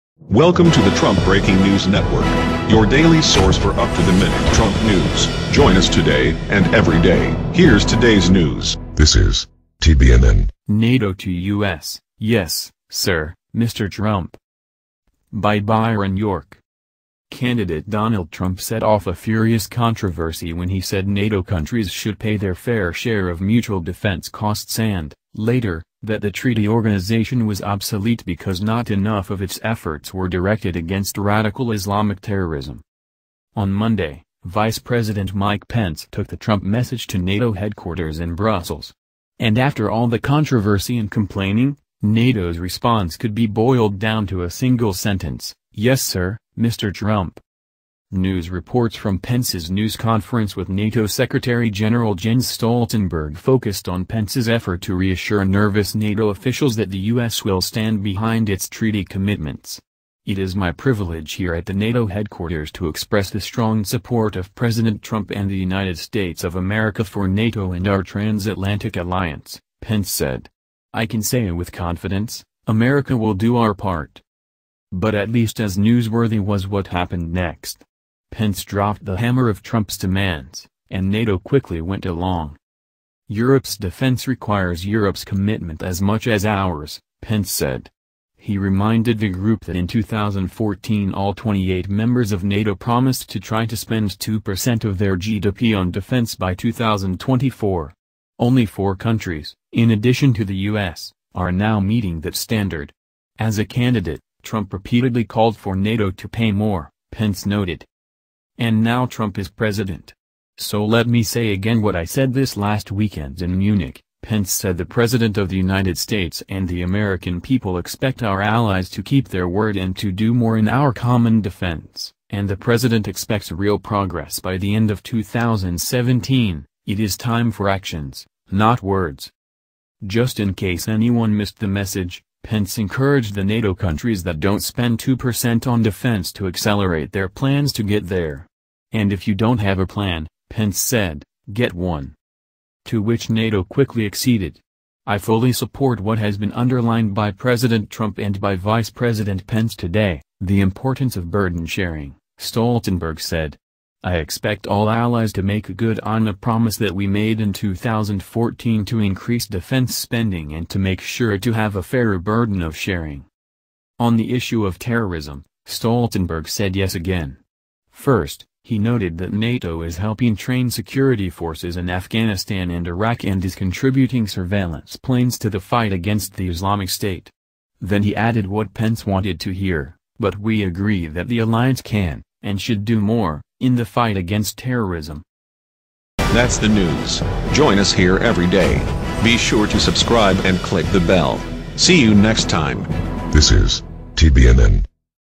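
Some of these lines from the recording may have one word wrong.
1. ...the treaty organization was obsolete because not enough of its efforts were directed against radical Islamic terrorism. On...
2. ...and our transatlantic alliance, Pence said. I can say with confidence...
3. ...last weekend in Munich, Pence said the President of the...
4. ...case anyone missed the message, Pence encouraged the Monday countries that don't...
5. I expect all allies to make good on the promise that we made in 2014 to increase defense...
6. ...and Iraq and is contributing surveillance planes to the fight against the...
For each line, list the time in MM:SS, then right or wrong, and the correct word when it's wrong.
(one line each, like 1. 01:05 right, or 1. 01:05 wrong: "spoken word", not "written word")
1. 00:26 right
2. 01:07 right
3. 01:52 right
4. 02:10 wrong: "NATO", not "Monday"
5. 02:34 right
6. 02:52 right.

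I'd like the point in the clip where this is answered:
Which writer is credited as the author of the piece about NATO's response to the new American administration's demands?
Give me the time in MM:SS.
00:15.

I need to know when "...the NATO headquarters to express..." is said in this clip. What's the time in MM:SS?
01:01.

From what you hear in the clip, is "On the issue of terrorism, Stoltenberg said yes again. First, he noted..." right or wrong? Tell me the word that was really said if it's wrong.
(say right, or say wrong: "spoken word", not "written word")
right.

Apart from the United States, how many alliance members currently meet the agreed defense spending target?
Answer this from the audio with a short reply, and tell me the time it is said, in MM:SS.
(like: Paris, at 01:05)
4, at 01:38.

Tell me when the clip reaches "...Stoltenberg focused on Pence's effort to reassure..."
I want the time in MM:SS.
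00:52.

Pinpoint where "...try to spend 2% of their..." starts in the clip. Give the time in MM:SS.
01:33.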